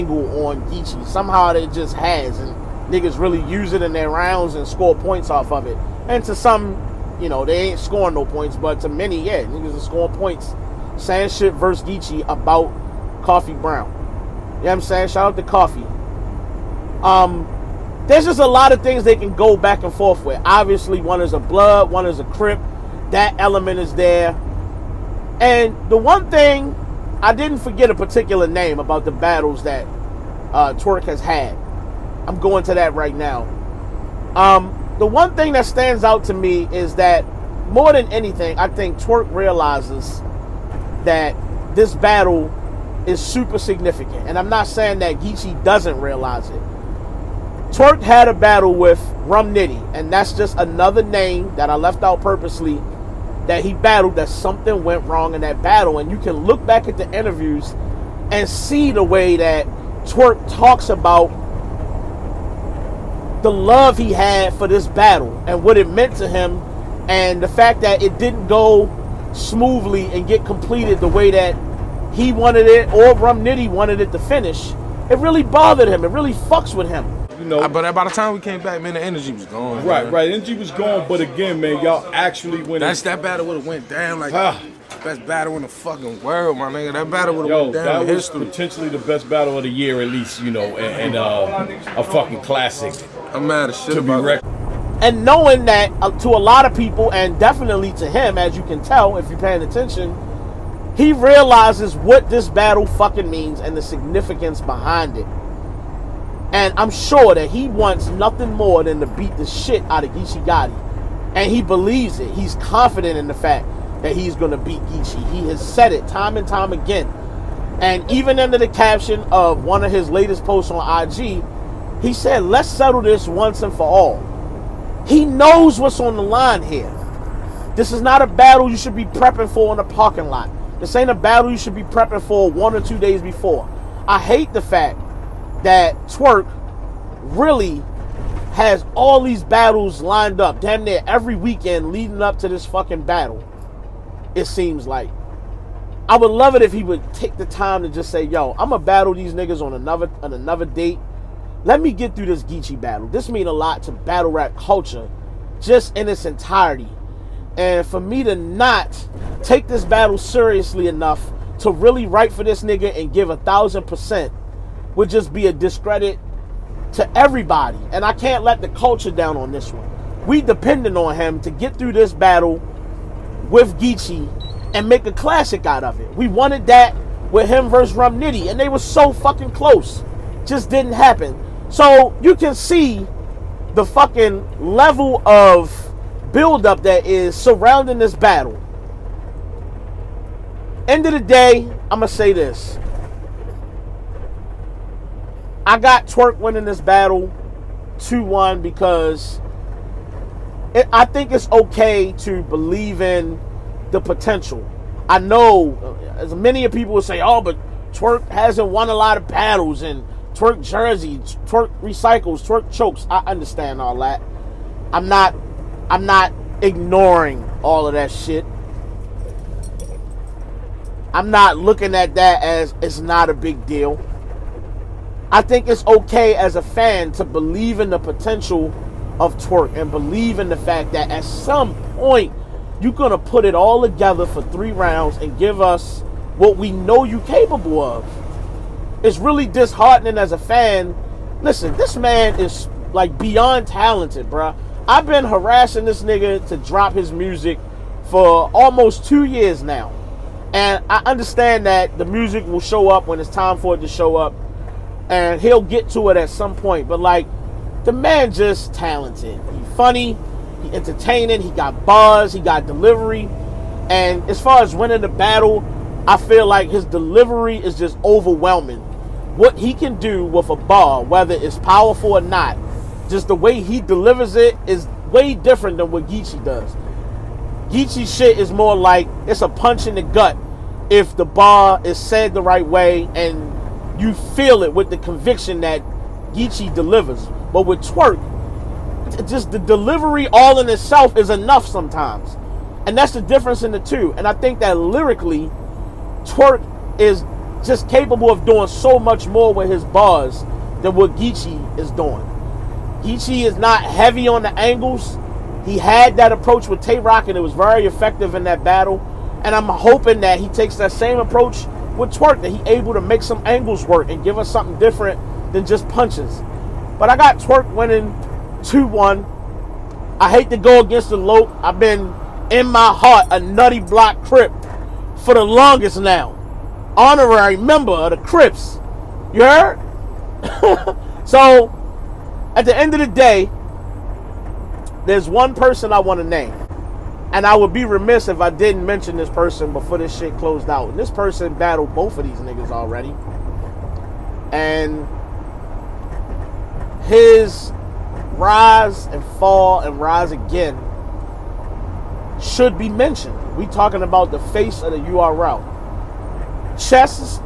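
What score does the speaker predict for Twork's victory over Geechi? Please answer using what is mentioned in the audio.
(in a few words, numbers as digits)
2-1.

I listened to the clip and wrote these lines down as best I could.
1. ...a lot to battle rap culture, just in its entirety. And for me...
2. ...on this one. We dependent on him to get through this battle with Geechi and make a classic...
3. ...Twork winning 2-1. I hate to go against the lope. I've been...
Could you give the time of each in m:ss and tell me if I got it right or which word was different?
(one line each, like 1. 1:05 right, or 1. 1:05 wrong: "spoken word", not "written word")
1. 2:33 right
2. 2:49 right
3. 5:17 right.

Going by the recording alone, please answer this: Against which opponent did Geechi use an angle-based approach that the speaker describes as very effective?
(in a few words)
Tay Roc.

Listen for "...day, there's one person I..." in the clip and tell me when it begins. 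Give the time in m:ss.
5:33.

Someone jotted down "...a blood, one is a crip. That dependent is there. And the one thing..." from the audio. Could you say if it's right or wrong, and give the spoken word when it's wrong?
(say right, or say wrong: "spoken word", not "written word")
wrong: "element", not "dependent".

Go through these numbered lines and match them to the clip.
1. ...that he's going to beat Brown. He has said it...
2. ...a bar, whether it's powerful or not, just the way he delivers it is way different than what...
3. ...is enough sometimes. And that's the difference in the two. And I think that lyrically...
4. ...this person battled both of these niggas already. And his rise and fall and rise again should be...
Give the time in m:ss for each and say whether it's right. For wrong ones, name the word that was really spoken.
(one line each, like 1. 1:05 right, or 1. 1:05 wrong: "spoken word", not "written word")
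1. 1:54 wrong: "Geechi", not "Brown"
2. 4:30 right
3. 4:51 right
4. 5:40 right.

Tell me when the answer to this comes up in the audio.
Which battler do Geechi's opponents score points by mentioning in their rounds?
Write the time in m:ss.
0:13.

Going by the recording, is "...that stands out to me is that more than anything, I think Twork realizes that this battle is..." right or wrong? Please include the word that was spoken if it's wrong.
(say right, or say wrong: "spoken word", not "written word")
right.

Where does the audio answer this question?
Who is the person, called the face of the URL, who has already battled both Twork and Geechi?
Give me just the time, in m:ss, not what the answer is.
5:56.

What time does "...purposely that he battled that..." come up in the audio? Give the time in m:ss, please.
0:52.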